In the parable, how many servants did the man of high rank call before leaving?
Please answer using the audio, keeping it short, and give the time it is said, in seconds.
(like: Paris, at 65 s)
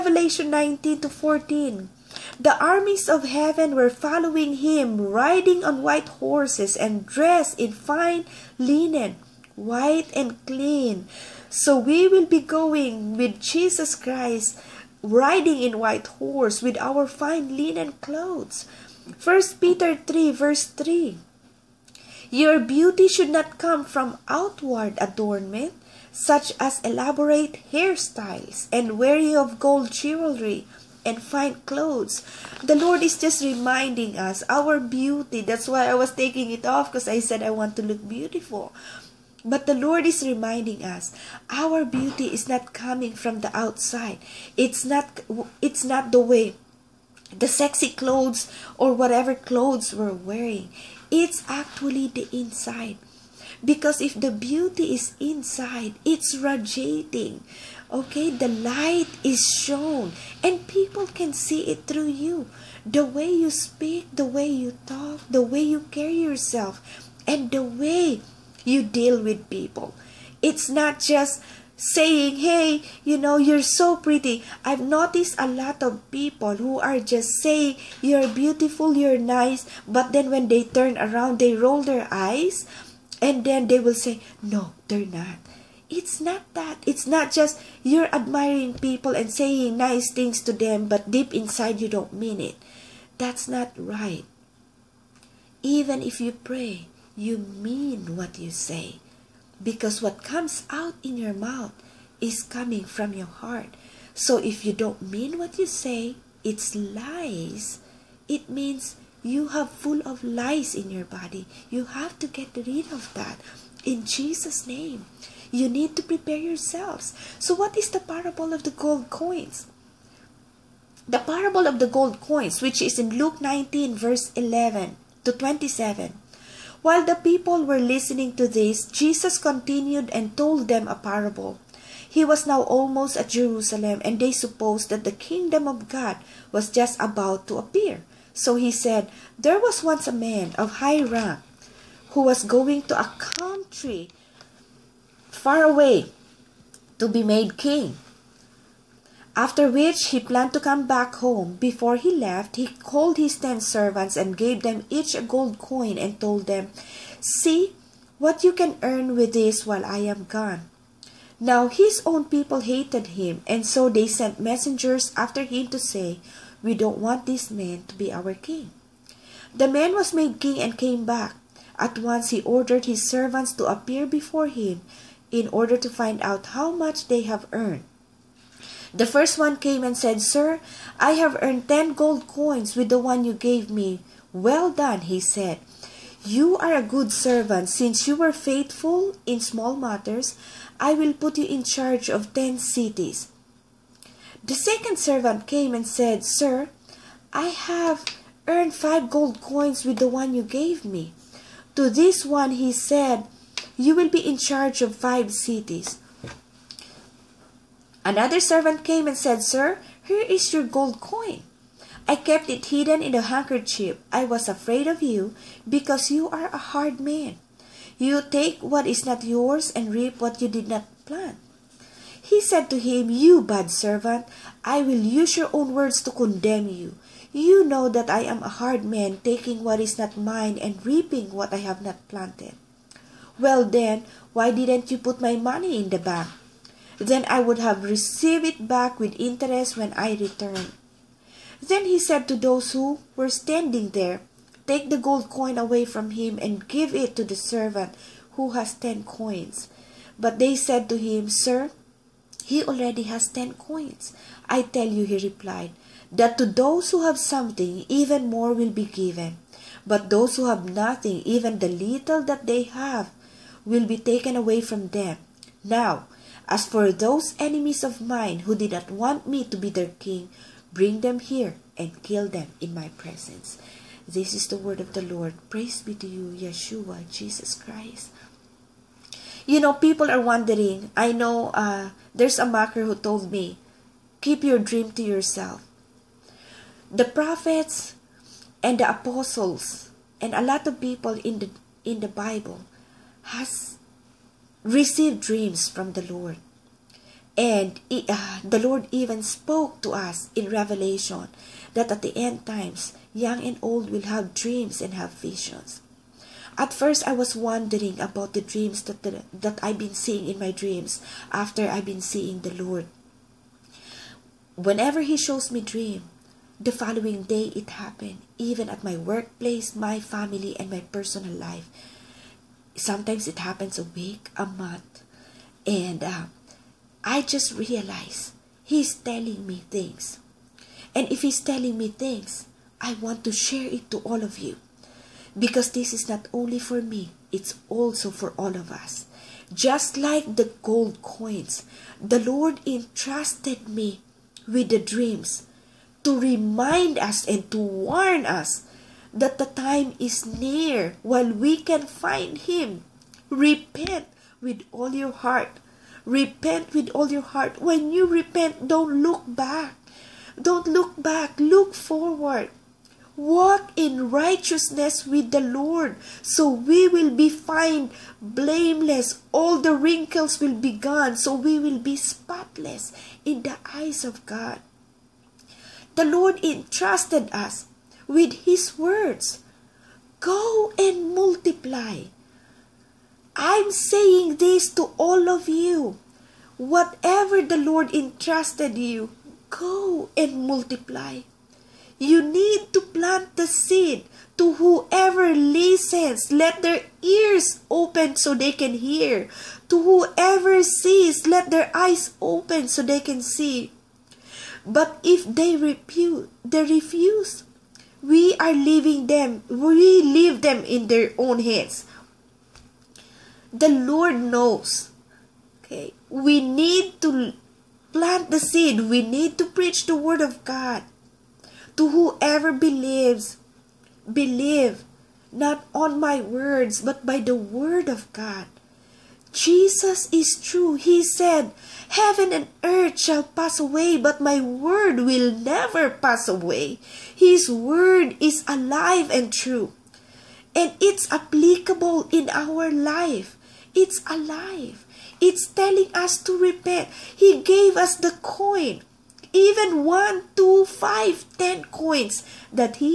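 10, at 153 s.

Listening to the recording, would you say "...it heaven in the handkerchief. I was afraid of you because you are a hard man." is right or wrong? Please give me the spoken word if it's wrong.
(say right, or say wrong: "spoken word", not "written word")
wrong: "hidden", not "heaven".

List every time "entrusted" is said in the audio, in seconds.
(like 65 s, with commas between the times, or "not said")
342 s, 376 s, 387 s.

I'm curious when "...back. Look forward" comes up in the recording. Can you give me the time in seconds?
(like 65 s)
361 s.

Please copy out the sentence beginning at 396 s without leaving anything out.
Let their ears open so they can hear.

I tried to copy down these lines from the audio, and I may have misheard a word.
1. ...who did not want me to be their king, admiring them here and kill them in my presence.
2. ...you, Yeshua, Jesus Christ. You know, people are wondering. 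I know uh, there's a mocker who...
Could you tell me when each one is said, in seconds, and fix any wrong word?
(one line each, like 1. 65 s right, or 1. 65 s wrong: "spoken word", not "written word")
1. 268 s wrong: "bring", not "admiring"
2. 276 s right.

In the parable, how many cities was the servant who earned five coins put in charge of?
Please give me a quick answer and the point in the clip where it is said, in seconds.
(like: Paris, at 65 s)
5, at 204 s.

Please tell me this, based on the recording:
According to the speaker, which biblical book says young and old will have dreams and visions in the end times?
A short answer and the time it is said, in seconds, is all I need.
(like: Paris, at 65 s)
Revelation, at 300 s.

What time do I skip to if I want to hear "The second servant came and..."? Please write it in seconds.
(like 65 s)
194 s.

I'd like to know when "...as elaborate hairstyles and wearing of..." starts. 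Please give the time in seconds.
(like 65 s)
26 s.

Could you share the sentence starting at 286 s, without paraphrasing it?
The prophets and the apostles and a lot of people in the in the Bible has Receive dreams from the Lord.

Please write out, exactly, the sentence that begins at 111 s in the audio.
You have to get rid of that in Jesus' name.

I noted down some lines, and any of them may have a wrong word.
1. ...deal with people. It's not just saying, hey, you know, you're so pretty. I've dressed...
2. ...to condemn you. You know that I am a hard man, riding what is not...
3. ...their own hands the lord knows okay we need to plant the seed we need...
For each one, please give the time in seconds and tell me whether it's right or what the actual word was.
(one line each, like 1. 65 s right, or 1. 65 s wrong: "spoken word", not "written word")
1. 68 s wrong: "noticed", not "dressed"
2. 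226 s wrong: "taking", not "riding"
3. 410 s right.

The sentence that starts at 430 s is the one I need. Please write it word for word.
He said, Heaven and earth shall pass away, but my word will never pass away.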